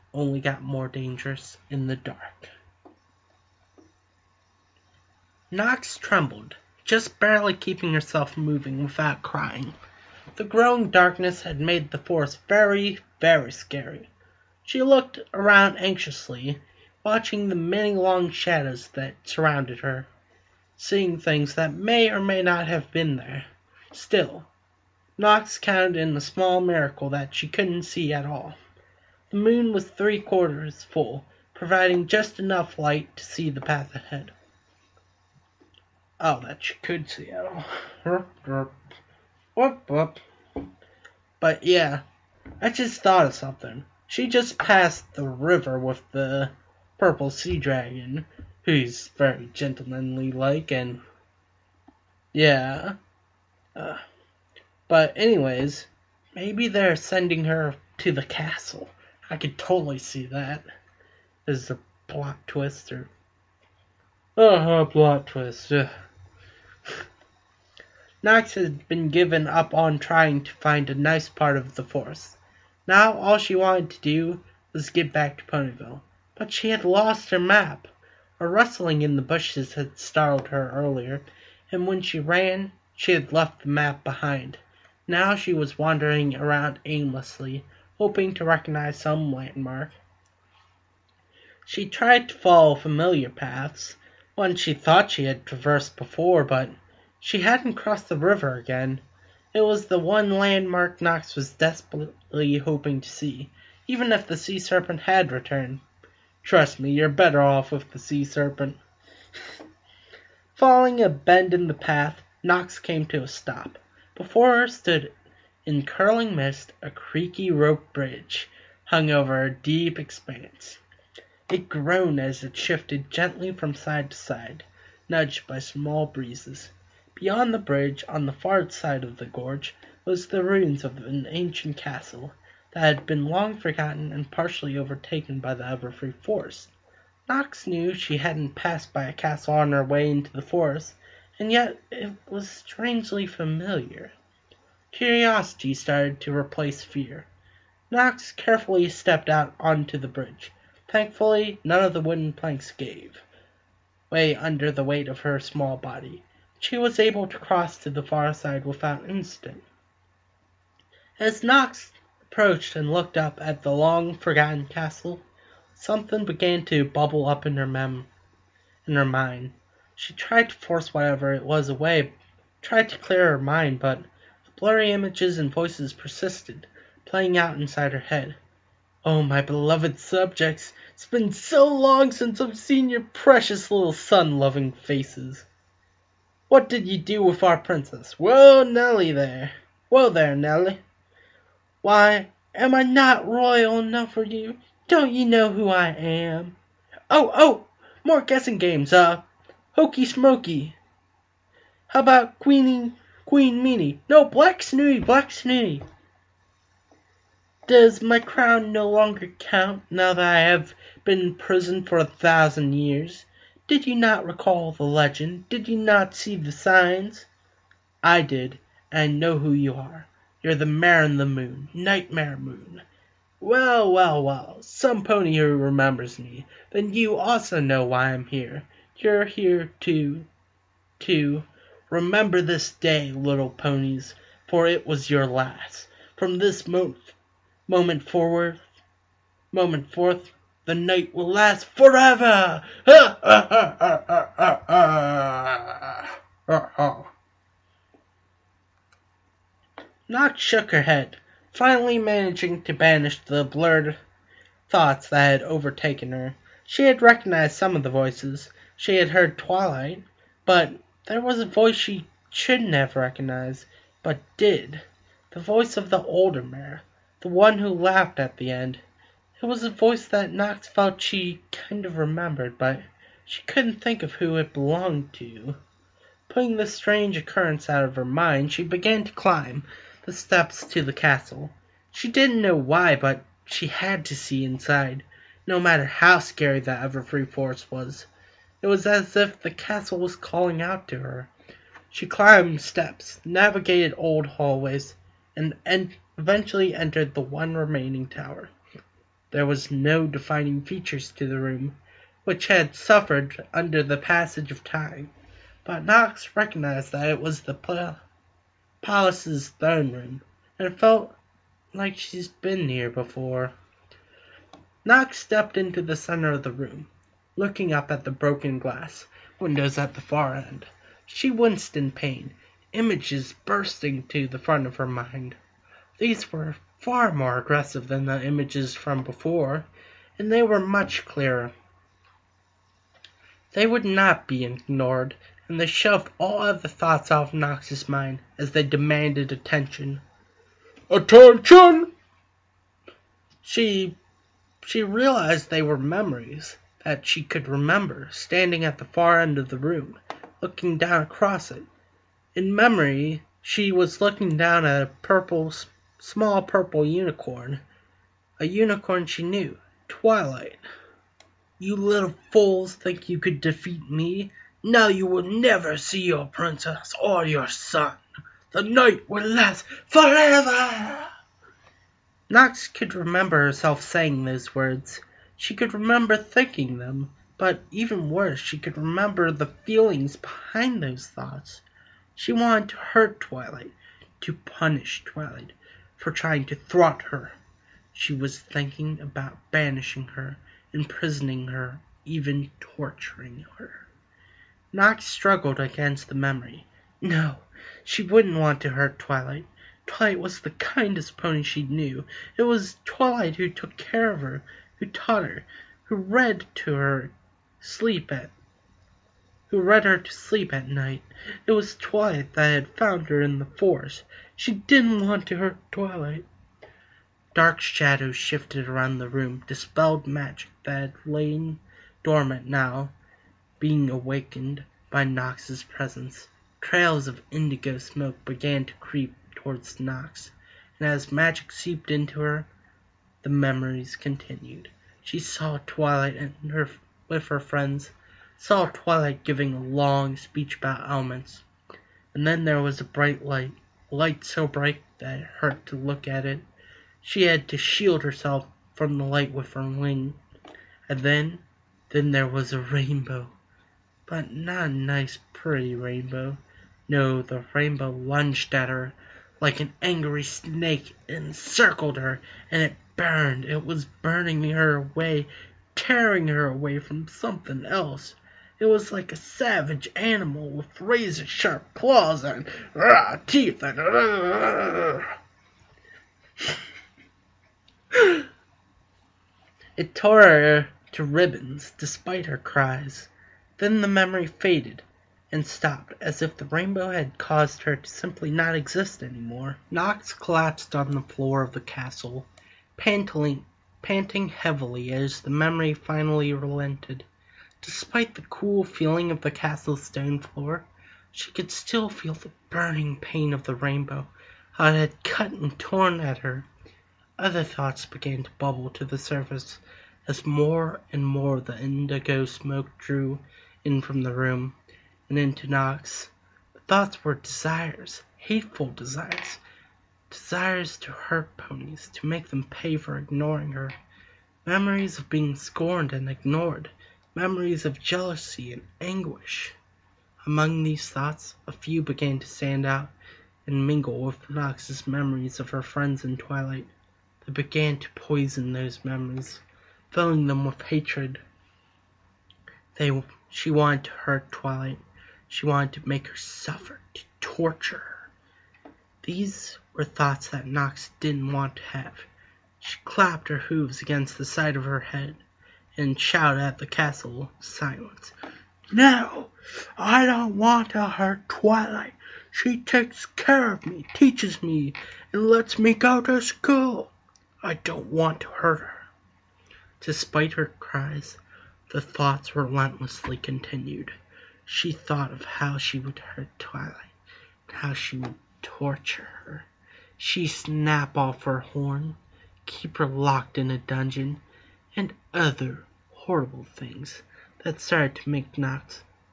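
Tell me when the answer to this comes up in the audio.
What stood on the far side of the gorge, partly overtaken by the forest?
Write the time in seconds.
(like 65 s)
131 s.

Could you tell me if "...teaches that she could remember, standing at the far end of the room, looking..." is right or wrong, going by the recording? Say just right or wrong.
wrong.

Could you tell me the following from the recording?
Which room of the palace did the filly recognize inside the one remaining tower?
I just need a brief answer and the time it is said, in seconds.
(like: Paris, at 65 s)
throne room, at 309 s.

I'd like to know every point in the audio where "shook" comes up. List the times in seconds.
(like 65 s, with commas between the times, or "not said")
250 s.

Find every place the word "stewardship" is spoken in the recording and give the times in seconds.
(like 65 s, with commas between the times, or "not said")
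not said.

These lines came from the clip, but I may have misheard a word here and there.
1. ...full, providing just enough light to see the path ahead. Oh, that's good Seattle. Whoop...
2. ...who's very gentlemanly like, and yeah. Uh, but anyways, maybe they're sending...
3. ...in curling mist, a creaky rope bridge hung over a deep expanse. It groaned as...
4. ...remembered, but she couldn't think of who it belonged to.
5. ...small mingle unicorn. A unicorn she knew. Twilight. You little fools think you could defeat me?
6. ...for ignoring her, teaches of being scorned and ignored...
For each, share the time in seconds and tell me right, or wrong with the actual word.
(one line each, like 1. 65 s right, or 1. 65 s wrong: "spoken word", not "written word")
1. 30 s right
2. 48 s right
3. 115 s right
4. 271 s right
5. 356 s wrong: "purple", not "mingle"
6. 522 s wrong: "memories", not "teaches".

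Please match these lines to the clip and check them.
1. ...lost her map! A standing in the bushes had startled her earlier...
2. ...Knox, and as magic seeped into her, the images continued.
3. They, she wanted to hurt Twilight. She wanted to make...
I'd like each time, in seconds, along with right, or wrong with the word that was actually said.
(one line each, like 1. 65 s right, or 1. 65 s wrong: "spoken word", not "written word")
1. 76 s wrong: "rustling", not "standing"
2. 429 s wrong: "memories", not "images"
3. 542 s right.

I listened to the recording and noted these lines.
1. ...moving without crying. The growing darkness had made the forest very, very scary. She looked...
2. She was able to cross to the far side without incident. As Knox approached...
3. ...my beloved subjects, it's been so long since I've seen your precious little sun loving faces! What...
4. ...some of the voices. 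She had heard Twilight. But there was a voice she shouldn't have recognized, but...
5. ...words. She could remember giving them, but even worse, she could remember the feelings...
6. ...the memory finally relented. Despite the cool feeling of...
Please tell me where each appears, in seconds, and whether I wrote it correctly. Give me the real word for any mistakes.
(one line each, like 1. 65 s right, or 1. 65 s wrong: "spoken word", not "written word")
1. 8 s right
2. 156 s right
3. 179 s right
4. 257 s right
5. 374 s wrong: "thinking", not "giving"
6. 495 s right.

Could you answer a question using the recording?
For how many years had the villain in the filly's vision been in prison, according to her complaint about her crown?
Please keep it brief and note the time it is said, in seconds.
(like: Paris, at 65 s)
1000, at 212 s.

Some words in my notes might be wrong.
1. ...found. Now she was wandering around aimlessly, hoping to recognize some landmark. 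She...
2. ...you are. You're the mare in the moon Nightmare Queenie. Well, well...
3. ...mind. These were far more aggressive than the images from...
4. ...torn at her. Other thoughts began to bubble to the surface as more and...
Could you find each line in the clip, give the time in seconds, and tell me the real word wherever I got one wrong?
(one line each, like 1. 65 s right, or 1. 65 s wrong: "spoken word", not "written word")
1. 84 s wrong: "behind", not "found"
2. 219 s wrong: "Moon", not "Queenie"
3. 324 s right
4. 505 s right.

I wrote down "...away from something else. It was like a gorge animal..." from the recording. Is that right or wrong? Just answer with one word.
wrong.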